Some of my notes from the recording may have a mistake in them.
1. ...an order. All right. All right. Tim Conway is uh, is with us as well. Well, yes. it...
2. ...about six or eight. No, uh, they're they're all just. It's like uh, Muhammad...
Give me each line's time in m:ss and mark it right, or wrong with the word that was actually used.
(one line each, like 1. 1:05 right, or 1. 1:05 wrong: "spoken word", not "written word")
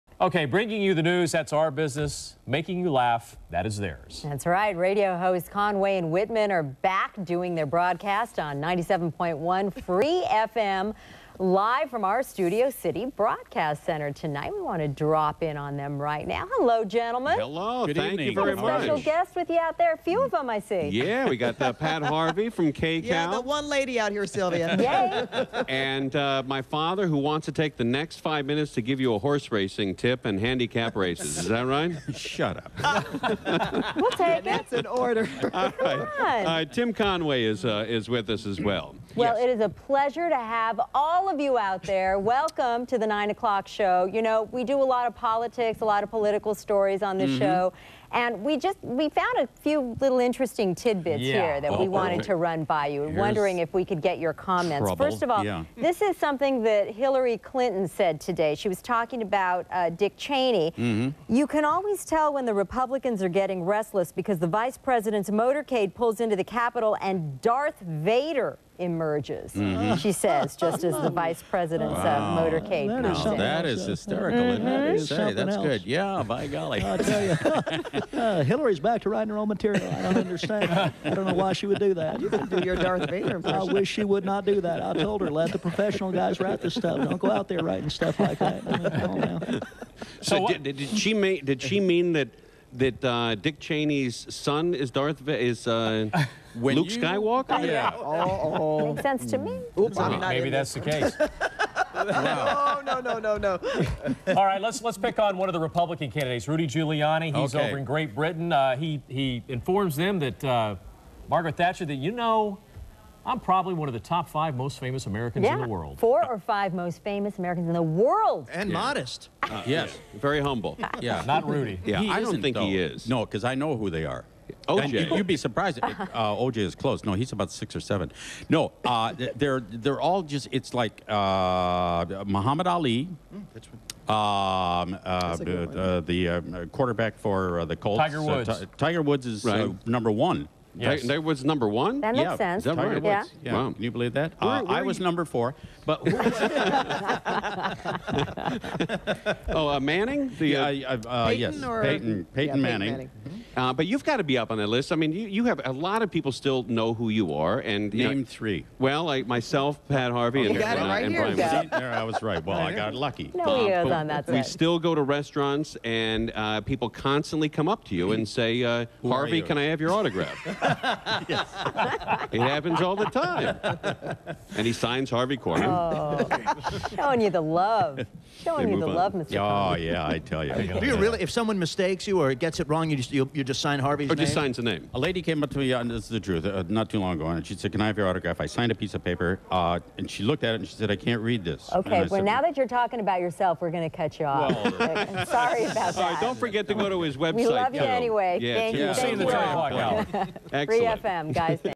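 1. 0:34 right
2. 2:07 wrong: "seven", not "eight".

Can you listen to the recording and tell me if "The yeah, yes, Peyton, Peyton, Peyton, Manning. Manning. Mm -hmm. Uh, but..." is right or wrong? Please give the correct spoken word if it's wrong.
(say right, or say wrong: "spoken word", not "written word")
right.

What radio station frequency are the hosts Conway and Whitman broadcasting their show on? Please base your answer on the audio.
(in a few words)
97.1 Free FM.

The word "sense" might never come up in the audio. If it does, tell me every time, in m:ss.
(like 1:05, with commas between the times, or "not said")
1:39, 2:22.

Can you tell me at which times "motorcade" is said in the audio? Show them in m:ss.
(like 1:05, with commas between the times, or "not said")
1:05, 1:12.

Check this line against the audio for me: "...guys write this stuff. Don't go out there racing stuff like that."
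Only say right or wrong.
wrong.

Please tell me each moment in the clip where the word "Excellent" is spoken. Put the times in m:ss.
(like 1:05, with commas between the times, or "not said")
3:20.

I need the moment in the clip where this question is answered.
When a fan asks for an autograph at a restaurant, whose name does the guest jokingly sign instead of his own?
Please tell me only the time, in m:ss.
2:55.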